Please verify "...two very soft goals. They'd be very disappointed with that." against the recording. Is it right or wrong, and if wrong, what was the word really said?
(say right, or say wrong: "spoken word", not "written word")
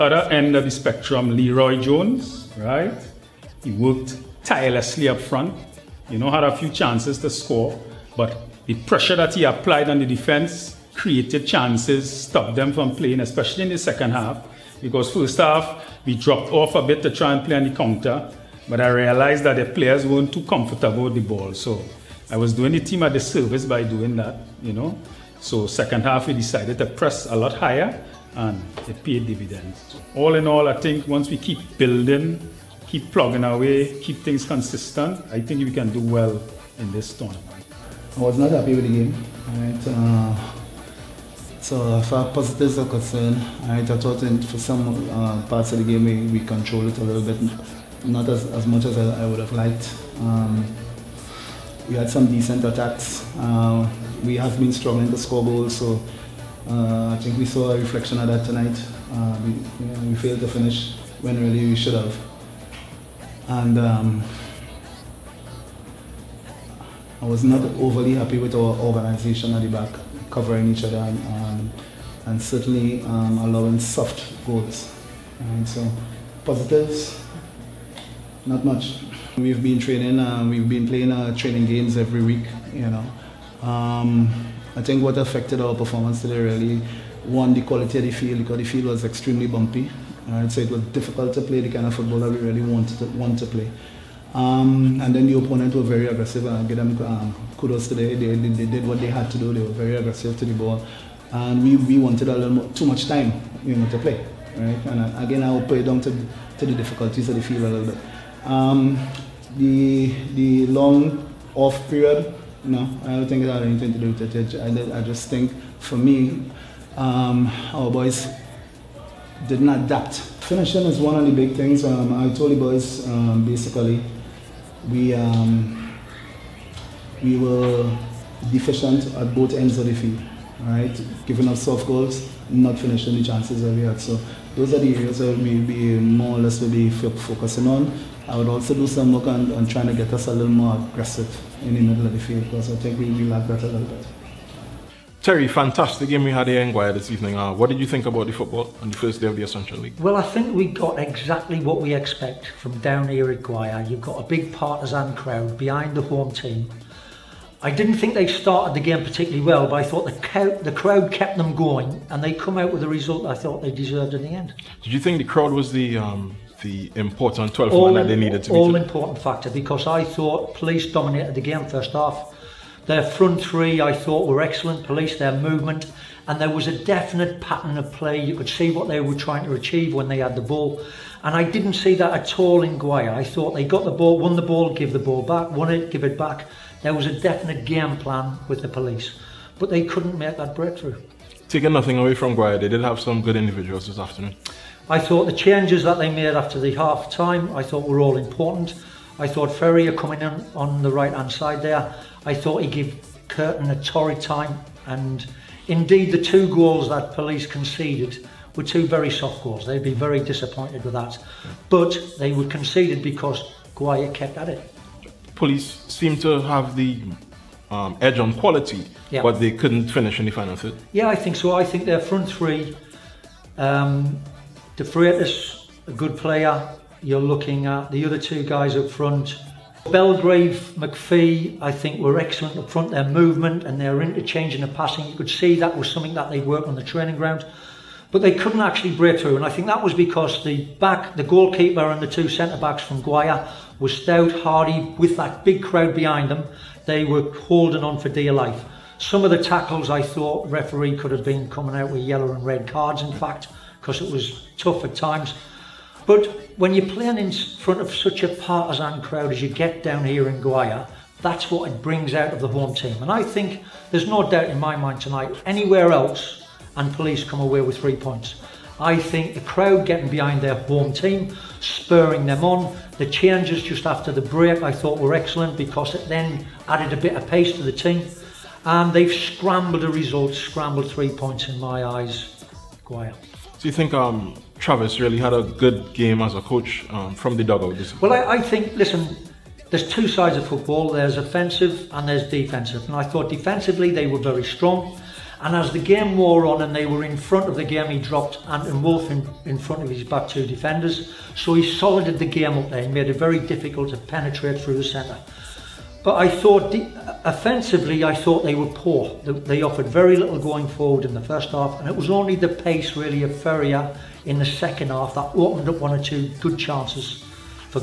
right.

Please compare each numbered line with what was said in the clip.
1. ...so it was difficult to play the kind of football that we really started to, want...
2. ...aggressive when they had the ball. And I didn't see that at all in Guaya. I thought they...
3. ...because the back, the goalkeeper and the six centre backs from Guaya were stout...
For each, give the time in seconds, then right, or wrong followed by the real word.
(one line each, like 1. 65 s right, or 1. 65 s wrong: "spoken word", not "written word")
1. 90 s wrong: "wanted", not "started"
2. 179 s wrong: "achieve", not "aggressive"
3. 239 s wrong: "two", not "six".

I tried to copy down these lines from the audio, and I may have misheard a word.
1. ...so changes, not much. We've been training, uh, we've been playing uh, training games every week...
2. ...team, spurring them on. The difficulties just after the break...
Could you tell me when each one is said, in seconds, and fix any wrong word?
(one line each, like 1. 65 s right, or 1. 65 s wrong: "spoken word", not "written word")
1. 75 s wrong: "positives", not "changes"
2. 270 s wrong: "changes", not "difficulties".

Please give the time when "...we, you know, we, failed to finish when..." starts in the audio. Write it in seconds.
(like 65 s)
59 s.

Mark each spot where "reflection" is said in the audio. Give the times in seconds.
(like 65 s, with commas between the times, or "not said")
57 s.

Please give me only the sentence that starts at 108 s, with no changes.
Um, the the long off period, you know, I don't think it had anything to do with it.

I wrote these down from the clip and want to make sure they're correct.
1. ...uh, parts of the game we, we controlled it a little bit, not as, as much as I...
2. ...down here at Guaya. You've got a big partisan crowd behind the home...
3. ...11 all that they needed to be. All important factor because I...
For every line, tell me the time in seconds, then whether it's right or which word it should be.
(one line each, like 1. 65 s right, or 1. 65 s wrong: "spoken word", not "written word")
1. 45 s right
2. 152 s right
3. 167 s wrong: "12", not "11".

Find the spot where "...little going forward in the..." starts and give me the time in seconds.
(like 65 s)
310 s.